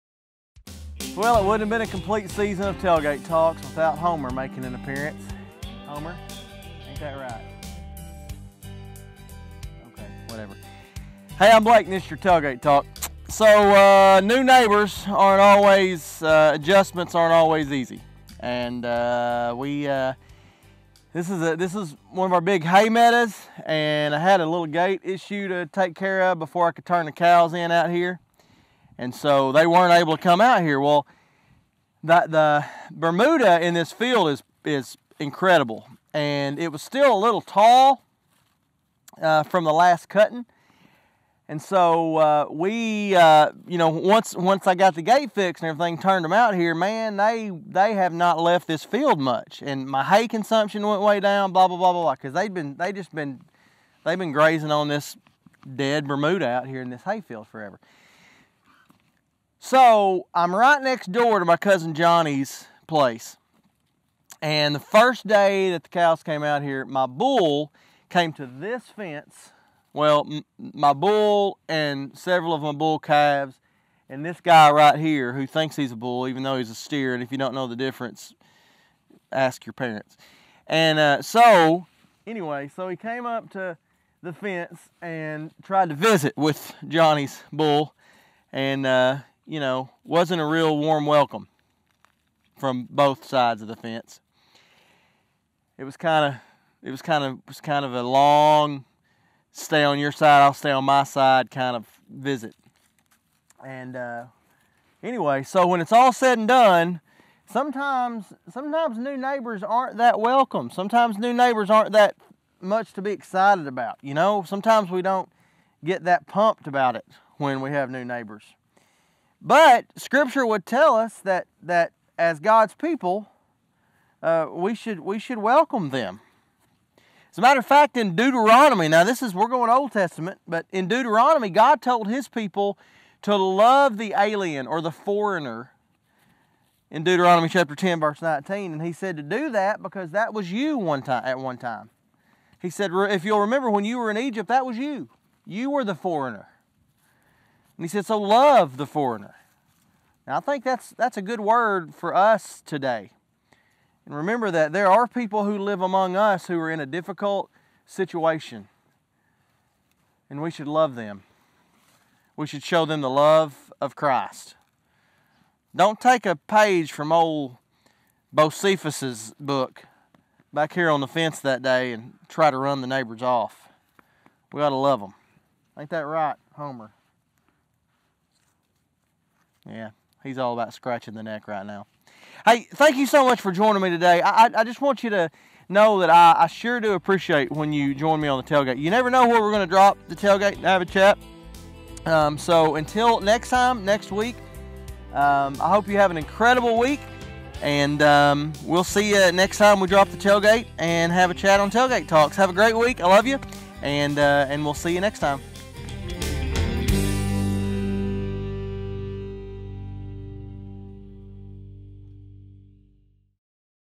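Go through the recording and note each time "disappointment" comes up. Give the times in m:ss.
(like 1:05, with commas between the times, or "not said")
not said.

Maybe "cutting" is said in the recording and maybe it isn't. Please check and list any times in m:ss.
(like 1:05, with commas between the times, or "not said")
0:40.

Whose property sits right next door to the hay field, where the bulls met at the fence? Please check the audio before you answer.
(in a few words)
Cousin Johnny's.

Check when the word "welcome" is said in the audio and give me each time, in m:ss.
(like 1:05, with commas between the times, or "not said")
1:31, 1:50, 2:05.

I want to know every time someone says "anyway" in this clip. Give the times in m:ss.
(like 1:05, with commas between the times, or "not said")
1:22, 1:45.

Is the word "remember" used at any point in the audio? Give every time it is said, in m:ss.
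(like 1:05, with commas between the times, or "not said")
2:23, 2:34.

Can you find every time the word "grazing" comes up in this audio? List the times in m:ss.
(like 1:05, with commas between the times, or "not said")
0:54.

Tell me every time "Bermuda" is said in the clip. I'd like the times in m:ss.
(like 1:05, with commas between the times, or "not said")
0:32, 0:56.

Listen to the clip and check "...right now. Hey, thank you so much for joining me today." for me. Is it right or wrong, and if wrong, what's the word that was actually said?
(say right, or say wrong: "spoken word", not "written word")
right.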